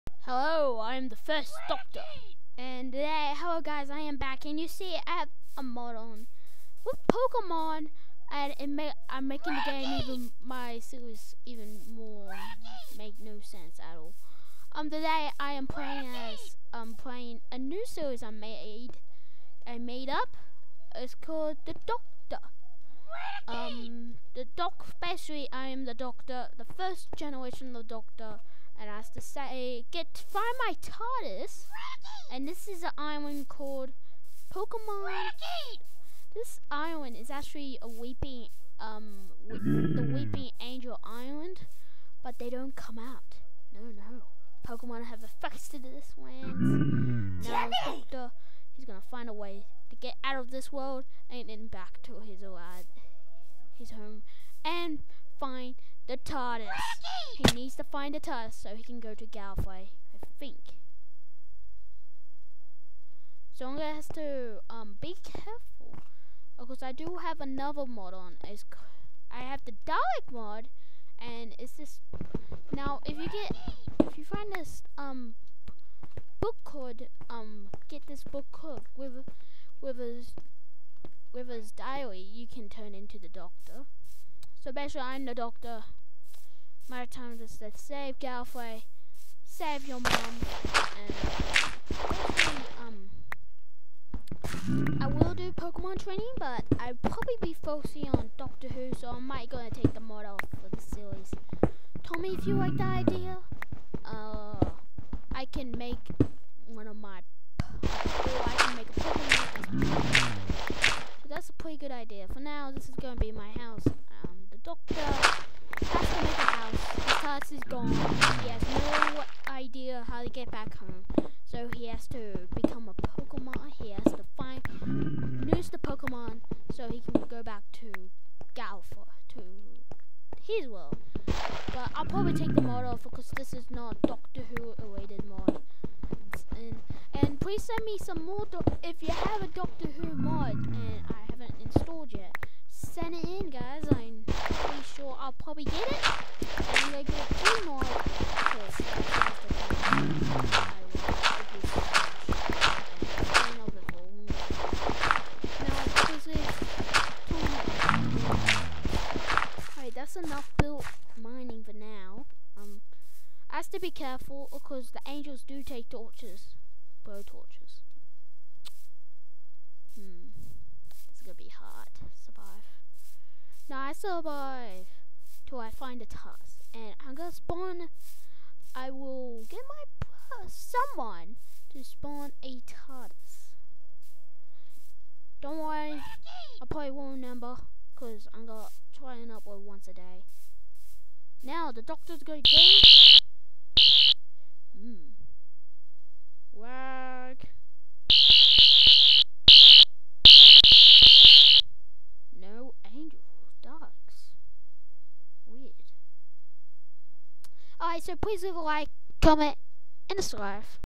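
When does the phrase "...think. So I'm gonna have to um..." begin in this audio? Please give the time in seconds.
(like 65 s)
60 s.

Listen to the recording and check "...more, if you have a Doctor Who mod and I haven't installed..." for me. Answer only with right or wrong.
right.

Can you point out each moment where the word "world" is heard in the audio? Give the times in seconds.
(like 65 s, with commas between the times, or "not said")
50 s, 130 s.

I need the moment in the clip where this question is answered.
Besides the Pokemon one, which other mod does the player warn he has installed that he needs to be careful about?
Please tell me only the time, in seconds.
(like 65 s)
69 s.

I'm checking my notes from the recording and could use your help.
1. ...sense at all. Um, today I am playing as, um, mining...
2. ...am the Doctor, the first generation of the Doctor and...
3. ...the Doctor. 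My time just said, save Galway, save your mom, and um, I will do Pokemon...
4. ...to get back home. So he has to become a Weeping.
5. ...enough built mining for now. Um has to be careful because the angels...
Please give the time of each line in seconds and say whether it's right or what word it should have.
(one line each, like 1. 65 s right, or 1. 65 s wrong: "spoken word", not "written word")
1. 13 s wrong: "playing", not "mining"
2. 25 s right
3. 85 s right
4. 120 s wrong: "Pokemon", not "Weeping"
5. 160 s right.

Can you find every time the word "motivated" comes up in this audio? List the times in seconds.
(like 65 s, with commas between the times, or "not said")
not said.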